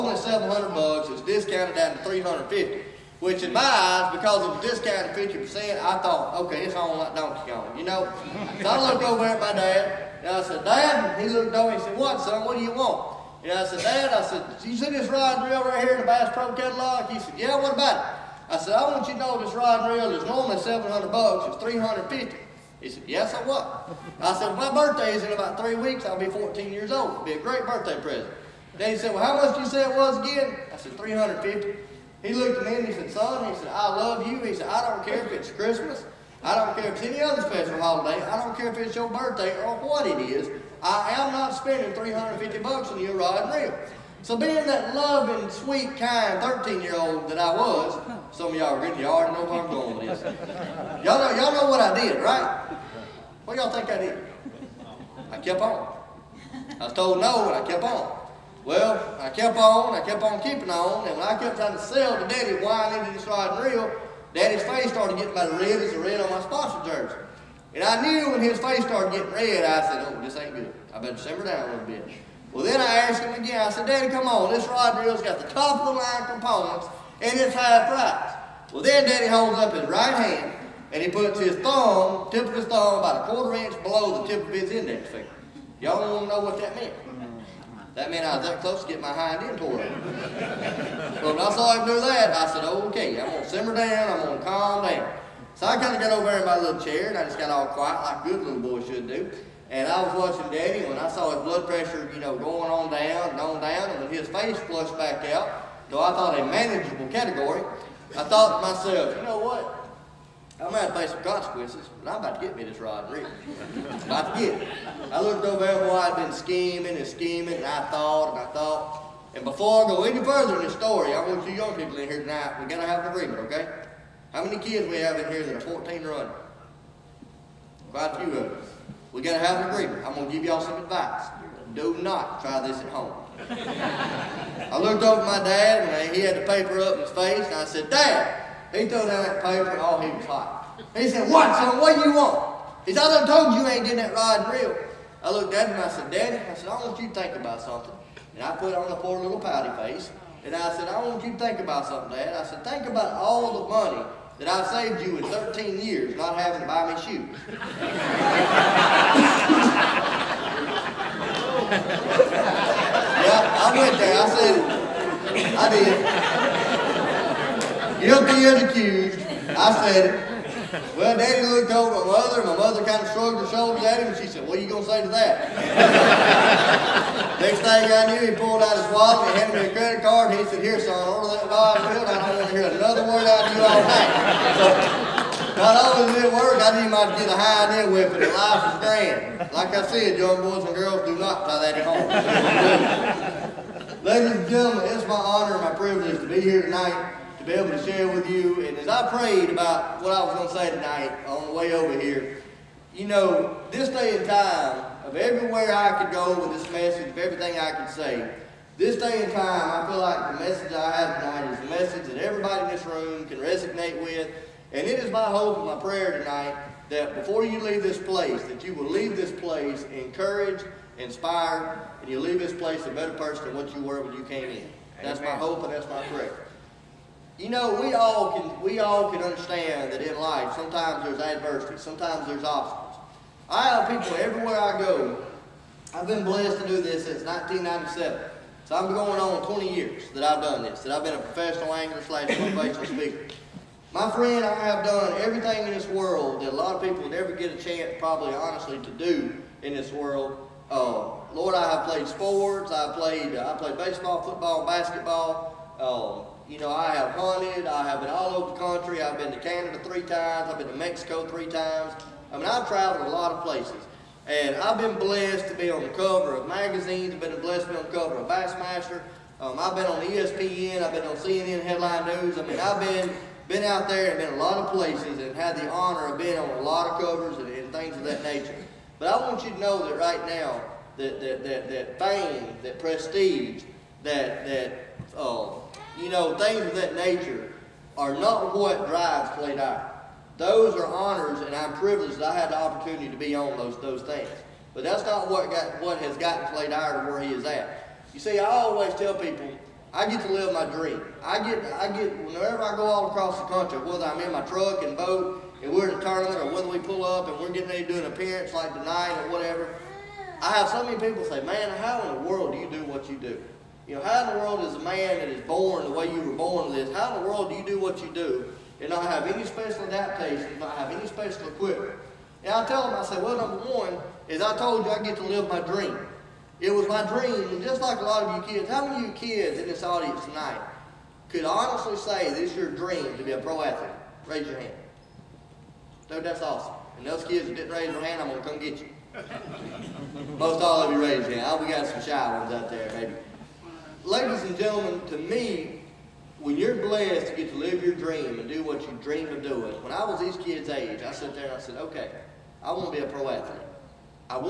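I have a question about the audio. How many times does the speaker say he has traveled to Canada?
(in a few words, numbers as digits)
3.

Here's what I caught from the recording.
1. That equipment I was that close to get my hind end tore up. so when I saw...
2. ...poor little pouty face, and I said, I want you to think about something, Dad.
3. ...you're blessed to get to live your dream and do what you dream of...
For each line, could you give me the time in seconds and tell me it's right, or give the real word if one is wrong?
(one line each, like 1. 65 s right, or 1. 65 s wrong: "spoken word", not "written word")
1. 87 s wrong: "meant", not "equipment"
2. 148 s right
3. 346 s right.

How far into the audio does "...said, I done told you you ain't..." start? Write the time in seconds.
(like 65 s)
142 s.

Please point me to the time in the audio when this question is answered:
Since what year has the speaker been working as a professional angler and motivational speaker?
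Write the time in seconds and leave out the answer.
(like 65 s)
237 s.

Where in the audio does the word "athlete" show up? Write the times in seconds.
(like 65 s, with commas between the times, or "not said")
333 s, 353 s.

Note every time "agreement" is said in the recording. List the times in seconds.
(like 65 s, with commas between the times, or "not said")
123 s, 129 s.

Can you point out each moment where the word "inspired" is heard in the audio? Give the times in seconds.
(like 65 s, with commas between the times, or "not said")
220 s.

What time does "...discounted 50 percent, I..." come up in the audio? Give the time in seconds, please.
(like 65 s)
4 s.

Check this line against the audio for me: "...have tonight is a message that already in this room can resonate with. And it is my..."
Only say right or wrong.
wrong.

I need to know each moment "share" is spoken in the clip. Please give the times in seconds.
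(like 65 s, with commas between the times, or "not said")
197 s.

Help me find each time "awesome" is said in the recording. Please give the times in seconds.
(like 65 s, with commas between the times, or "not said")
336 s.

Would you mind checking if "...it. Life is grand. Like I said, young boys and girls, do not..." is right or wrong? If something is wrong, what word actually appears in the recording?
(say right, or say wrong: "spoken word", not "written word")
right.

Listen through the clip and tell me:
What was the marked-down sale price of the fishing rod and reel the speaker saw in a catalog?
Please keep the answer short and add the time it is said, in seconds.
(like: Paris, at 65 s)
350, at 1 s.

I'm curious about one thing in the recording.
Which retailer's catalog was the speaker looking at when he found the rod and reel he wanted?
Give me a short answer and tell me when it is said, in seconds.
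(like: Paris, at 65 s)
Bass Pro, at 16 s.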